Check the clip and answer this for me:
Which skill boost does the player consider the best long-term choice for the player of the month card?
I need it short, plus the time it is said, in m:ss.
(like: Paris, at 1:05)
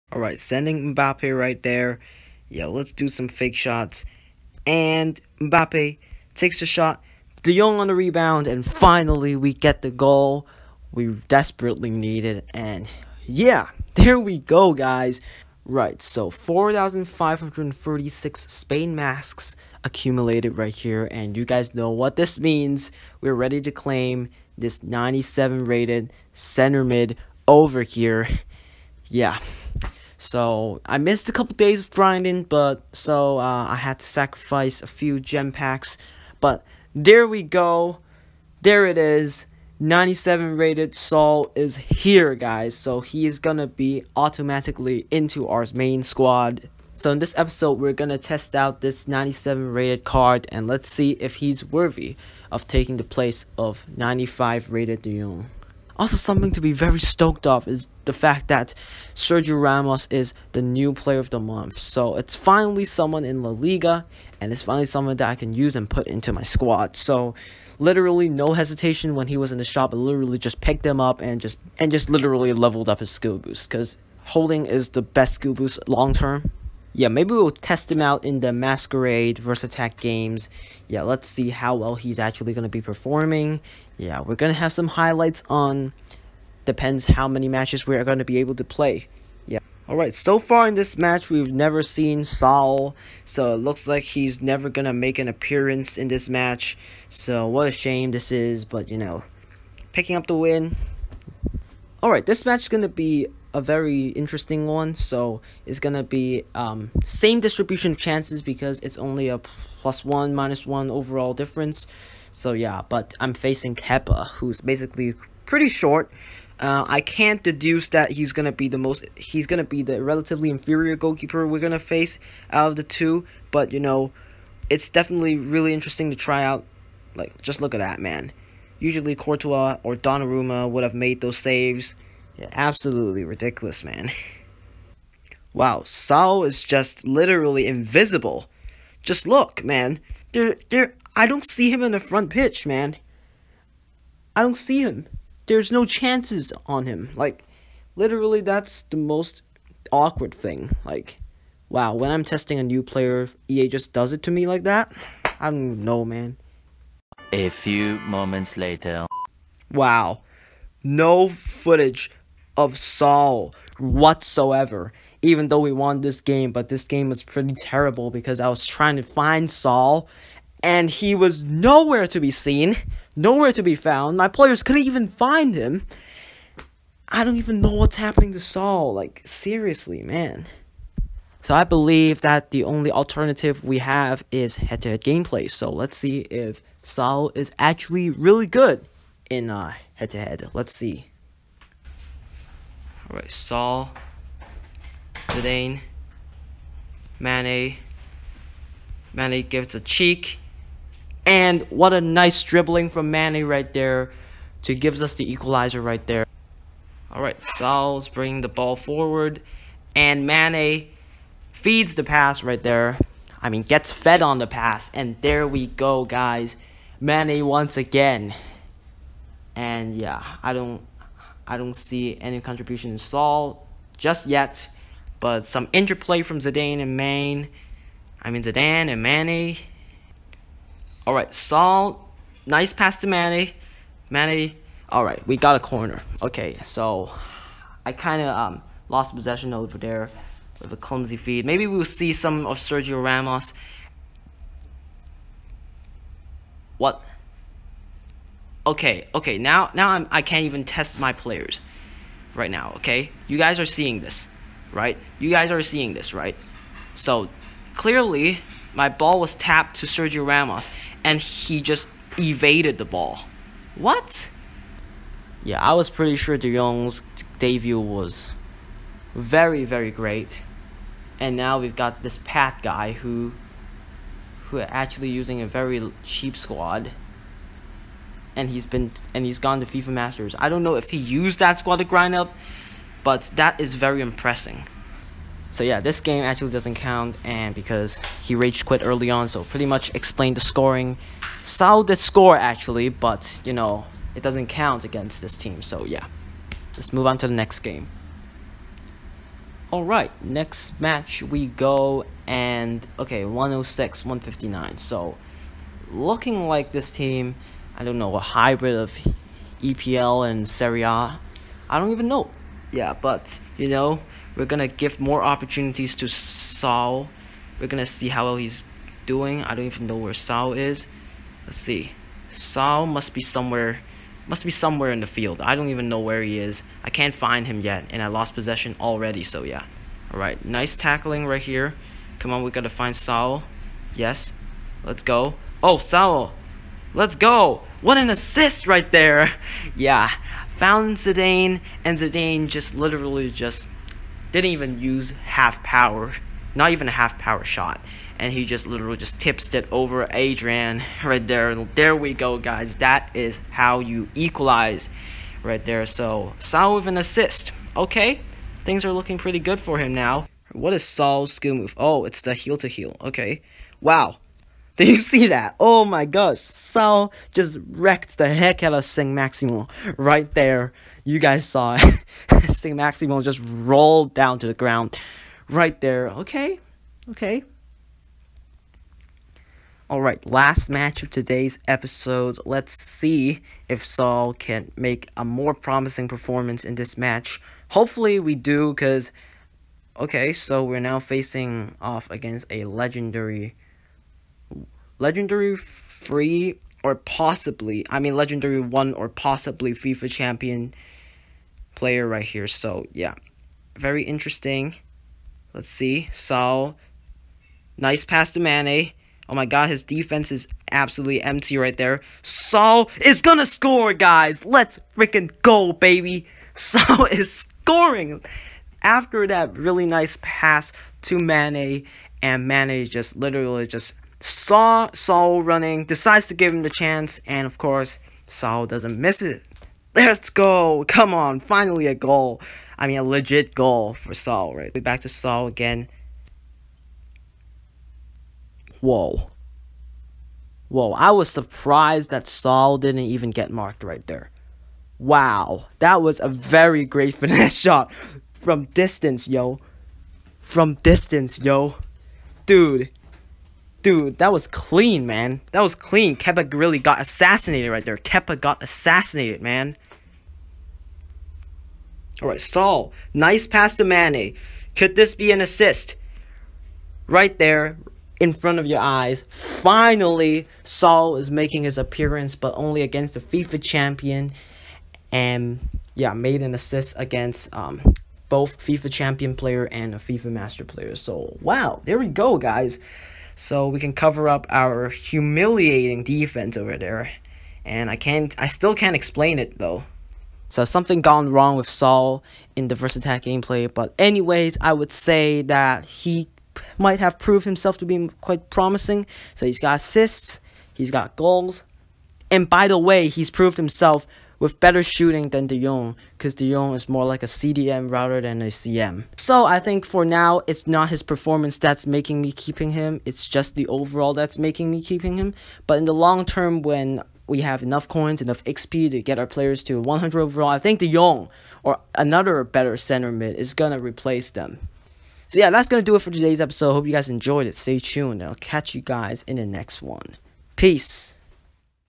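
Holding, at 1:14.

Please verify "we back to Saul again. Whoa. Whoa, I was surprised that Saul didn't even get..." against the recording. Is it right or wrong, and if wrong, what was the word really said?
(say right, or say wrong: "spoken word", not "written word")
right.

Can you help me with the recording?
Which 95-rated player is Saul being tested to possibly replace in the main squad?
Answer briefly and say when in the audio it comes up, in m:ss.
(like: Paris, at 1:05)
Dion, at 0:53.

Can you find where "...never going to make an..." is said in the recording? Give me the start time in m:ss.
1:34.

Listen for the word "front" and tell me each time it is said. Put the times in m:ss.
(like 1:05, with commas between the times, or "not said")
2:21, 7:48.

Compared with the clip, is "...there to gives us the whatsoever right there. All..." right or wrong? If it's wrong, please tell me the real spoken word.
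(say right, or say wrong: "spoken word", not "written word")
wrong: "equalizer", not "whatsoever".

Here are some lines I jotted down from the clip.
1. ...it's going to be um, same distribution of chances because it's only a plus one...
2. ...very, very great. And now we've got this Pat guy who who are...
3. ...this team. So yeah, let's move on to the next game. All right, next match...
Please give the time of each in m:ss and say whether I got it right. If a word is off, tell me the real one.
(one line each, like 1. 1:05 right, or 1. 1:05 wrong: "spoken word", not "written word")
1. 1:45 right
2. 4:29 right
3. 4:55 right.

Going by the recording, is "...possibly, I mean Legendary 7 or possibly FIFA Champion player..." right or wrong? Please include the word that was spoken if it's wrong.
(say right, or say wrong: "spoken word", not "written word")
wrong: "1", not "7".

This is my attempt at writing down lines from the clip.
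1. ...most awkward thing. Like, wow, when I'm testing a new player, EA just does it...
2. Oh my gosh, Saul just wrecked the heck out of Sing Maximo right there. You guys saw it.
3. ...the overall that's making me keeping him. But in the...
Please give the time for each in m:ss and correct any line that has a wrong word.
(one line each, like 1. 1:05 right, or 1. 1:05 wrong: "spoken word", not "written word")
1. 2:28 right
2. 6:05 right
3. 8:33 right.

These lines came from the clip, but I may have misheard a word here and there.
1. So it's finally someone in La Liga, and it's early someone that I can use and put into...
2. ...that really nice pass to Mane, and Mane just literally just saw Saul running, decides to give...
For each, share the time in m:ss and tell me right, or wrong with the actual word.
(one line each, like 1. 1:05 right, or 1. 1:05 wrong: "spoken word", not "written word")
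1. 1:01 wrong: "finally", not "early"
2. 6:59 right.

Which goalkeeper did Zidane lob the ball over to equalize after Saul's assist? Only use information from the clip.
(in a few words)
Adrian.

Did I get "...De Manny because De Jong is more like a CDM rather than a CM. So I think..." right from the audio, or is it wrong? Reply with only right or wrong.
wrong.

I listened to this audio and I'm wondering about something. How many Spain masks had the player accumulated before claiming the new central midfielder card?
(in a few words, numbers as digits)
4,536.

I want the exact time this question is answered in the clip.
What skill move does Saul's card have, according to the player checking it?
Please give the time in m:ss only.
6:02.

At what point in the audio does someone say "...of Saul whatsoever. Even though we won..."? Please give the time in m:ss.
2:42.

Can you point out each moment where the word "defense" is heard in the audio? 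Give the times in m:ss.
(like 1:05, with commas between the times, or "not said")
6:49, 8:06.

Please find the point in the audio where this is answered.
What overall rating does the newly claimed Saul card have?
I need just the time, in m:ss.
0:39.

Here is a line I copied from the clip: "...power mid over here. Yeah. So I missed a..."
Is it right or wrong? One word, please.
wrong.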